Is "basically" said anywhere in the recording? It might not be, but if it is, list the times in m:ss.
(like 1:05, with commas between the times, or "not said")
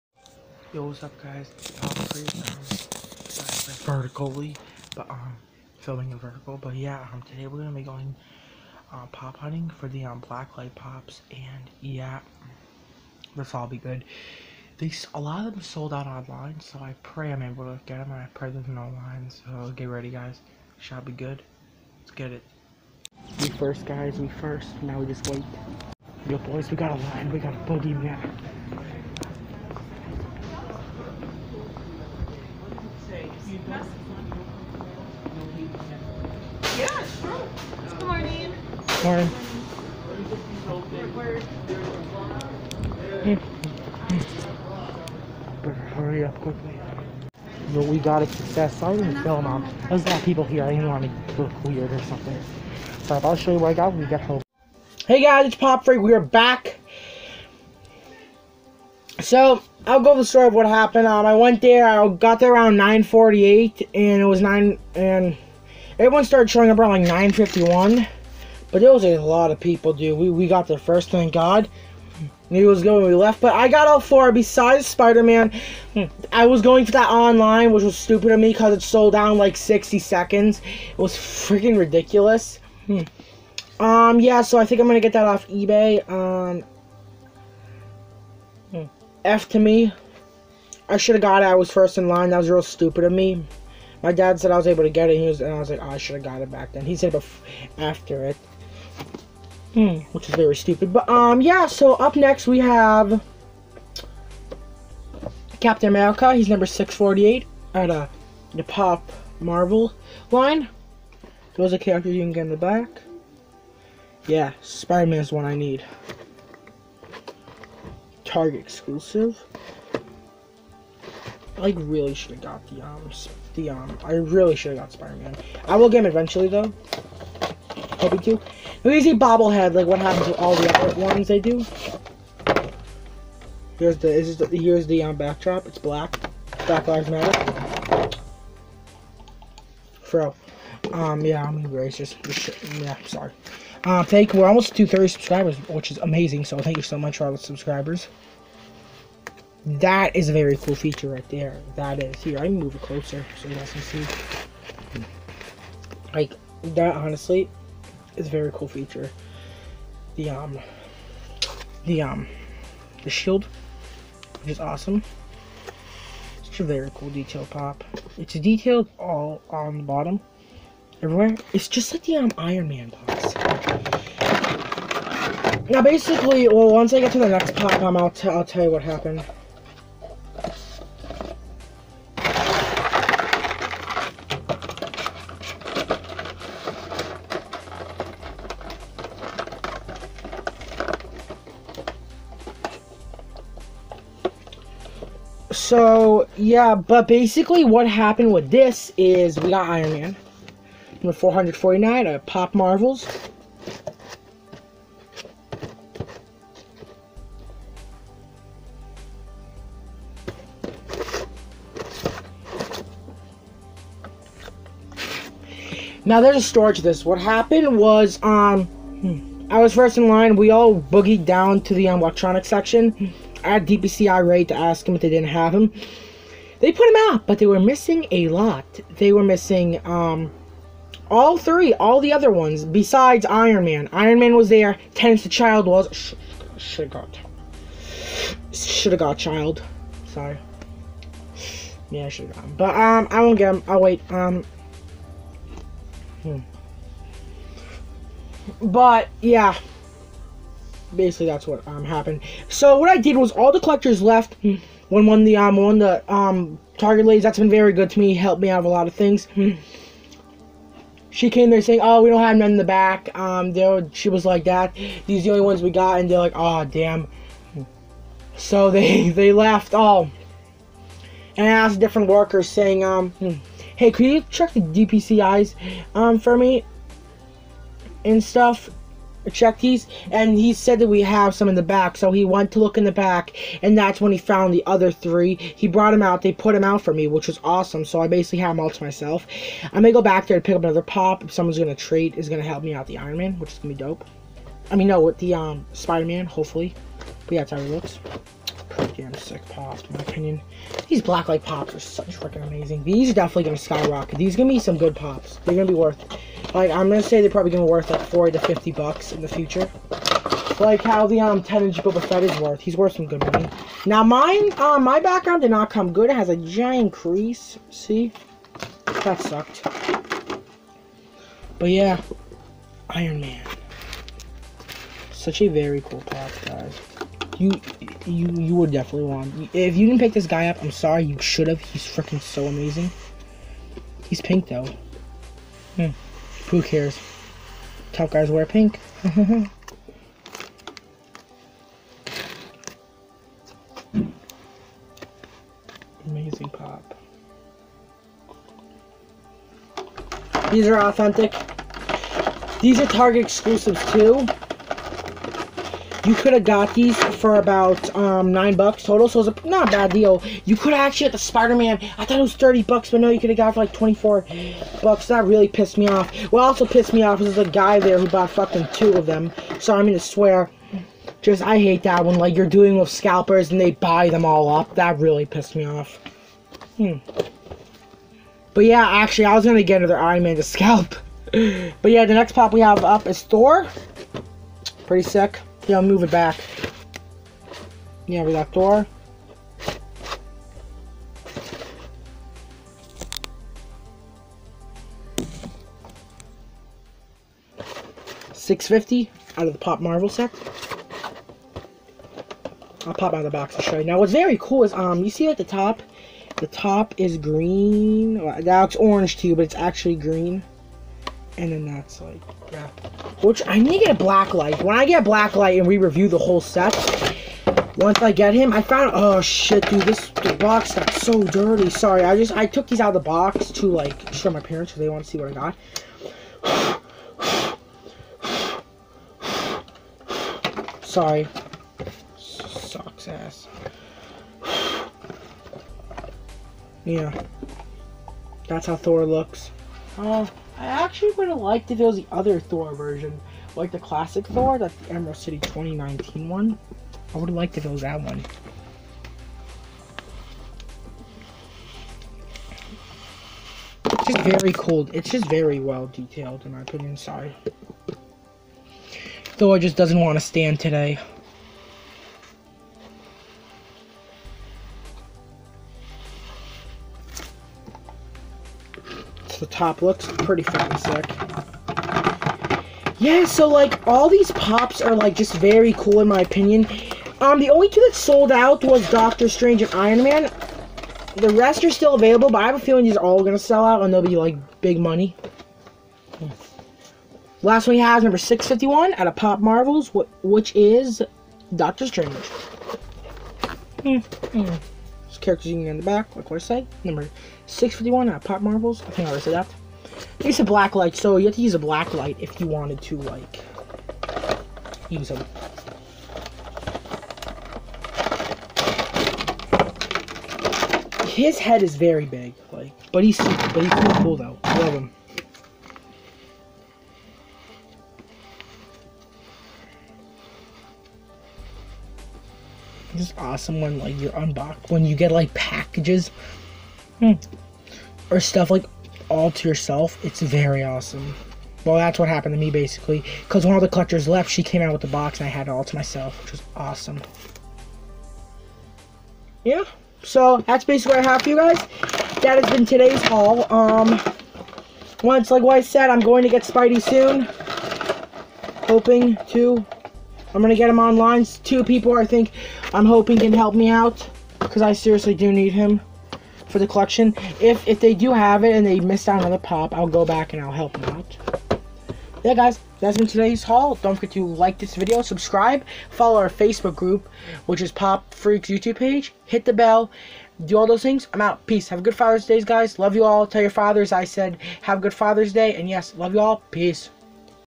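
2:55, 3:17, 4:10, 4:48, 8:52, 9:00.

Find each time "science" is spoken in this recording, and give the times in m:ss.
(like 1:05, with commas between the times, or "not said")
not said.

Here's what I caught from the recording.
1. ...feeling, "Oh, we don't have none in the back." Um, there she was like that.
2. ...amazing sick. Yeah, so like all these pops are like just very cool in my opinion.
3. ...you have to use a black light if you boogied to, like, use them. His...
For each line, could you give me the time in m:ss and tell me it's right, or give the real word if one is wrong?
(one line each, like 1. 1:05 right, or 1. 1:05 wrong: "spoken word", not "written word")
1. 4:21 wrong: "saying", not "feeling"
2. 7:50 wrong: "fucking", not "amazing"
3. 8:21 wrong: "wanted", not "boogied".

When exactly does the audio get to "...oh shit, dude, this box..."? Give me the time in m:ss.
6:58.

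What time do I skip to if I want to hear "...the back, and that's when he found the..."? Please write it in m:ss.
4:42.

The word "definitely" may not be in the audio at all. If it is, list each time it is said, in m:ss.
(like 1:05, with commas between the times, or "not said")
5:03, 5:28.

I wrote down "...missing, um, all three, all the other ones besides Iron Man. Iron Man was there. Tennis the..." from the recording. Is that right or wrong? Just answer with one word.
right.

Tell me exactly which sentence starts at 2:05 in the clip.
I will get him eventually though.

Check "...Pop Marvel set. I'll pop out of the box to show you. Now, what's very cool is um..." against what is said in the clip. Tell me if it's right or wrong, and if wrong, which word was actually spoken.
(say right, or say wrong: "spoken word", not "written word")
right.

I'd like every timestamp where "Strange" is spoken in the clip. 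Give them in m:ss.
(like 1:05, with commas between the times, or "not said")
7:59, 8:11.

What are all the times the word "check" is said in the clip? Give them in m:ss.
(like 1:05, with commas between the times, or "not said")
4:34, 4:39.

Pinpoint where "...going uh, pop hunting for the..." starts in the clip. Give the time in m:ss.
0:07.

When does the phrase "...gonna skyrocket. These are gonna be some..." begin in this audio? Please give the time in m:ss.
5:03.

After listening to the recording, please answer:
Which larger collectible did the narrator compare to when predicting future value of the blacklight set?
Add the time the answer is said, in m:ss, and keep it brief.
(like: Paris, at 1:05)
10 inch Boba Fett, at 5:11.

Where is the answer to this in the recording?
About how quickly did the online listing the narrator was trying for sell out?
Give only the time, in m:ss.
1:19.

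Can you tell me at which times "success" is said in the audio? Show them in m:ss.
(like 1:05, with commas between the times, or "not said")
0:48.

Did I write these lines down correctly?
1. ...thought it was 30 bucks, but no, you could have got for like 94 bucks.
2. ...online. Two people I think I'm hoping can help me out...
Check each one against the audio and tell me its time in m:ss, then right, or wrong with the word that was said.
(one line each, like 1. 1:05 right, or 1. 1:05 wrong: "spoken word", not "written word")
1. 6:02 wrong: "24", not "94"
2. 9:10 right.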